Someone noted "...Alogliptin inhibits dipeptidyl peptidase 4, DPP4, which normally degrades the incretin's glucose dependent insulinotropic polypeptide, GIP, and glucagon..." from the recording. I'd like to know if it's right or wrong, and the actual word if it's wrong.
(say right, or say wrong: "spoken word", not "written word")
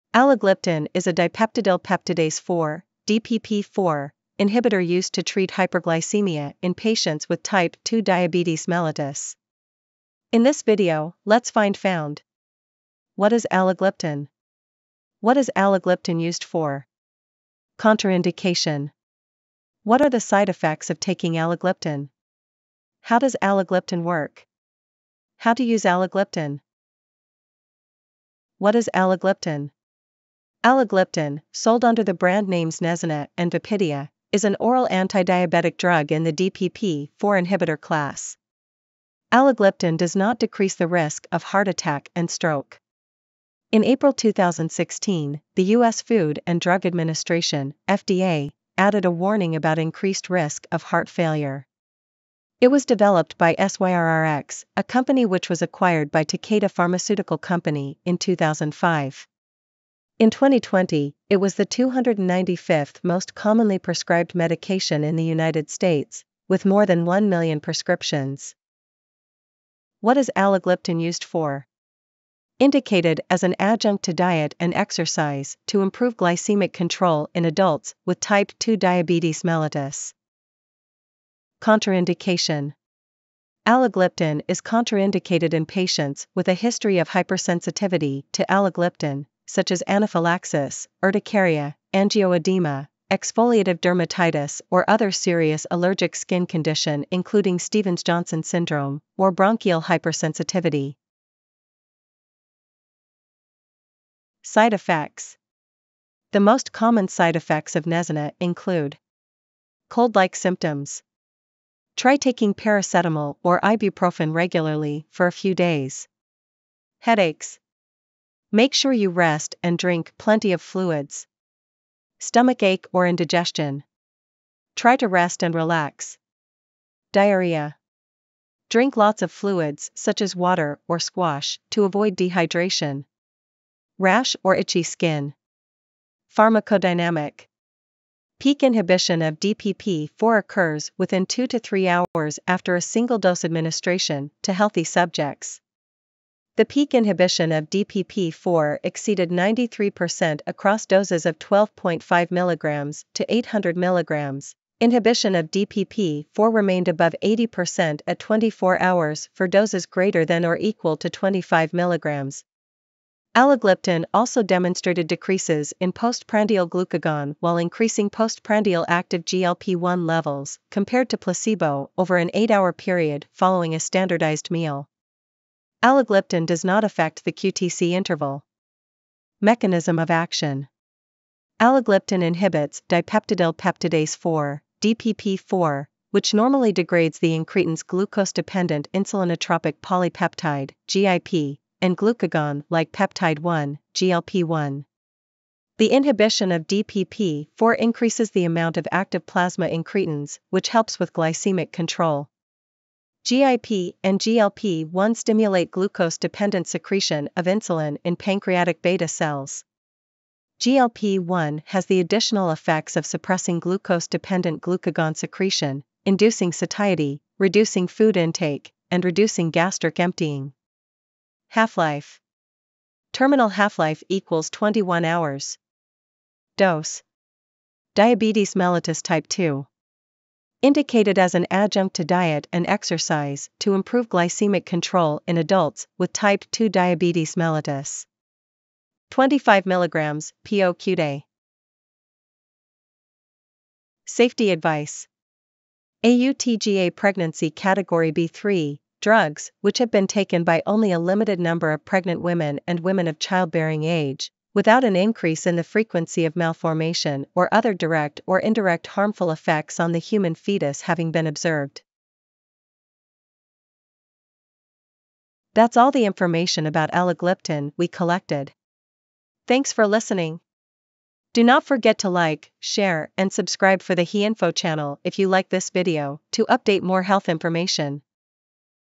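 right.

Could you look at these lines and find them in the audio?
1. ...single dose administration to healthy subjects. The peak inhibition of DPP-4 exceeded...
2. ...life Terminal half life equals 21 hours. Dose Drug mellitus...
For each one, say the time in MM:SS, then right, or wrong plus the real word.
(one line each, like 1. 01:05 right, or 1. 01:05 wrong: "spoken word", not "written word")
1. 02:22 right
2. 03:41 wrong: "Diabetes", not "Drug".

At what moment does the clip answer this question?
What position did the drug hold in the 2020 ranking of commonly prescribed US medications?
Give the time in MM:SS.
01:01.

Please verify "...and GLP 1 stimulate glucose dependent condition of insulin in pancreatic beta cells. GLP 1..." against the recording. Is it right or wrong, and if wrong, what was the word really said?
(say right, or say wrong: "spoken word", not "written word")
wrong: "secretion", not "condition".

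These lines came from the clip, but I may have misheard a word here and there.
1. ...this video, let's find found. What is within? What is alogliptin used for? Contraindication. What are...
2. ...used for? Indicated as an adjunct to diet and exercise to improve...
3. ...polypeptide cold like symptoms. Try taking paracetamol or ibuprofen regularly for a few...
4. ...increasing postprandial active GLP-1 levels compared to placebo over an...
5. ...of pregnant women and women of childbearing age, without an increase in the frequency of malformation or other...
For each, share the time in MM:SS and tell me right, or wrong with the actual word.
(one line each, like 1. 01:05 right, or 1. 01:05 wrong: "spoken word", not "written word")
1. 00:10 wrong: "alogliptin", not "within"
2. 01:11 right
3. 01:48 wrong: "include", not "polypeptide"
4. 02:47 right
5. 04:11 right.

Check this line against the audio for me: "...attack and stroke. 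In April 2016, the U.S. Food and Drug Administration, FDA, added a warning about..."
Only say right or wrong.
right.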